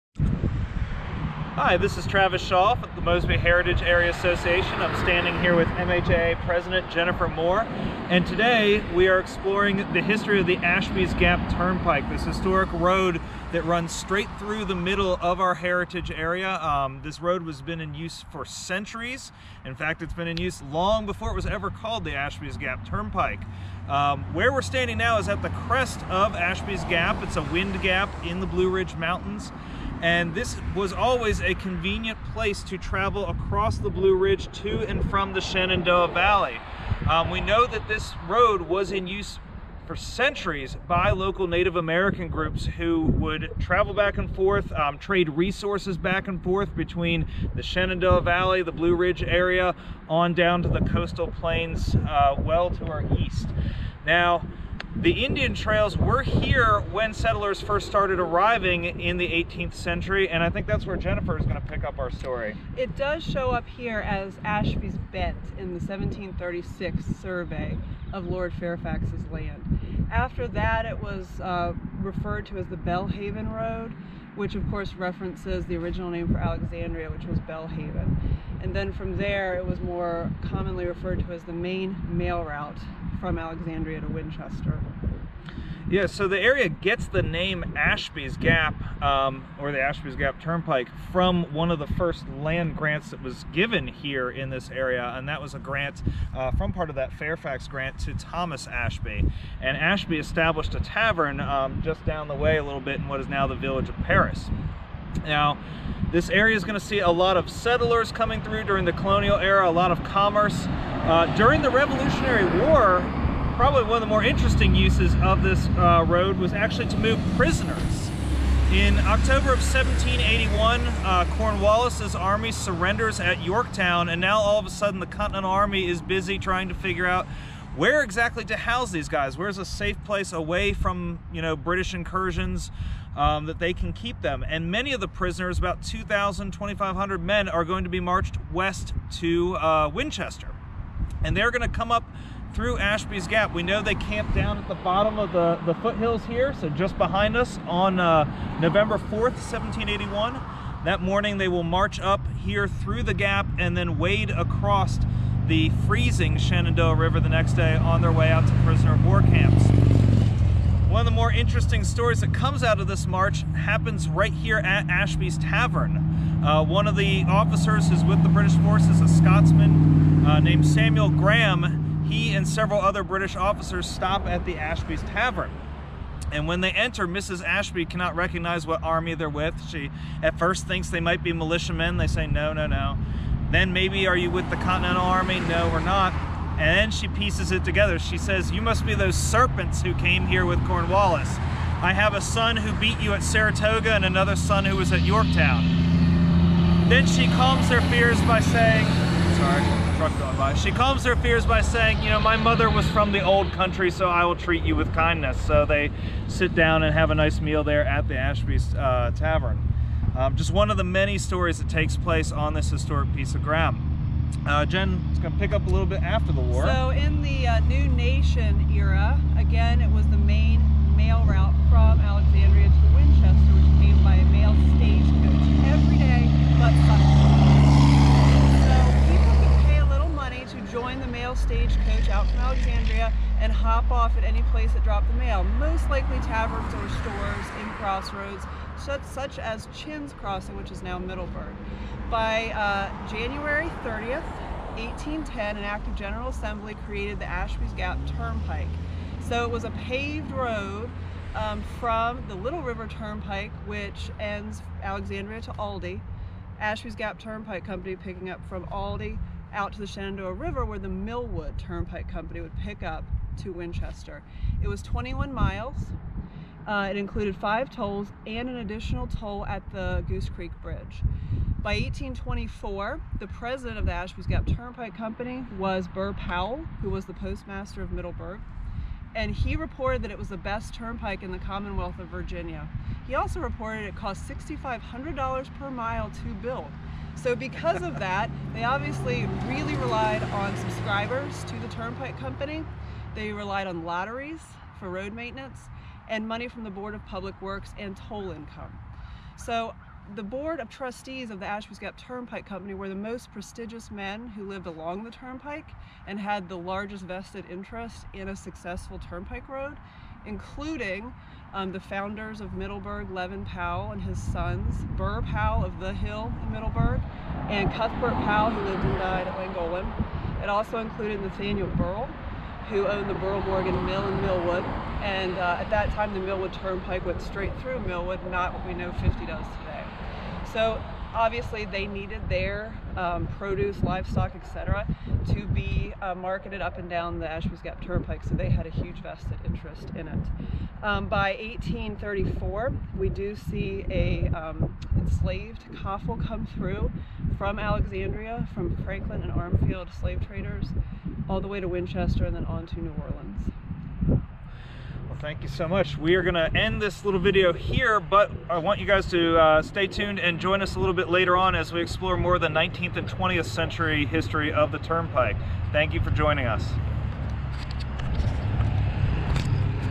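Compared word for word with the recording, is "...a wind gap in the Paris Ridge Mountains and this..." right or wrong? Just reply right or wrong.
wrong.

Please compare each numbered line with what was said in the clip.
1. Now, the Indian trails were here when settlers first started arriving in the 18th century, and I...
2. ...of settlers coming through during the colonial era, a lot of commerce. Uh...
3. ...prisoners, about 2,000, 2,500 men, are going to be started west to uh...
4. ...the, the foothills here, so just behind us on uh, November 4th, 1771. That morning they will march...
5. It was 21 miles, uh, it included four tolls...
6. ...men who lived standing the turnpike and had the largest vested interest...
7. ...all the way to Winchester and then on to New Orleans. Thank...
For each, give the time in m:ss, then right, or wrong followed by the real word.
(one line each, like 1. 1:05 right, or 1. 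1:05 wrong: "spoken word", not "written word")
1. 0:54 right
2. 1:47 right
3. 2:15 wrong: "marched", not "started"
4. 2:25 wrong: "1781", not "1771"
5. 4:24 wrong: "five", not "four"
6. 5:03 wrong: "along", not "standing"
7. 5:51 right.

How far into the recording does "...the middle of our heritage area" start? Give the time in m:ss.
0:14.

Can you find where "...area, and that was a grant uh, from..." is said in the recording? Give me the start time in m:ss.
1:34.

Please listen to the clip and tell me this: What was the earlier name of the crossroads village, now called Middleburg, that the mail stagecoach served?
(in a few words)
Chinn's Crossing.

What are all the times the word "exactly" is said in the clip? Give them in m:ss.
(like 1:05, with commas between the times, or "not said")
2:08.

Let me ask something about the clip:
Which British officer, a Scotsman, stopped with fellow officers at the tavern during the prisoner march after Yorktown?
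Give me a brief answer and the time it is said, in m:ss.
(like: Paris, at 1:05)
Samuel Graham, at 2:50.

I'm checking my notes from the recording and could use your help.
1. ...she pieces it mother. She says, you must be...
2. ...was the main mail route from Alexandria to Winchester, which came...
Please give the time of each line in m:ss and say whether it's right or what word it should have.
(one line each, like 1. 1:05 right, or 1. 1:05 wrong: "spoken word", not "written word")
1. 3:06 wrong: "together", not "mother"
2. 3:39 right.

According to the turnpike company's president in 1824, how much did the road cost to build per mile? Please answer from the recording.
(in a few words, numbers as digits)
$6,500.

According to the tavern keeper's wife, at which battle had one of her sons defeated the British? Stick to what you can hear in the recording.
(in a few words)
Saratoga.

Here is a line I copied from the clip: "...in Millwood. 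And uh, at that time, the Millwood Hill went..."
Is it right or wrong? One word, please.
wrong.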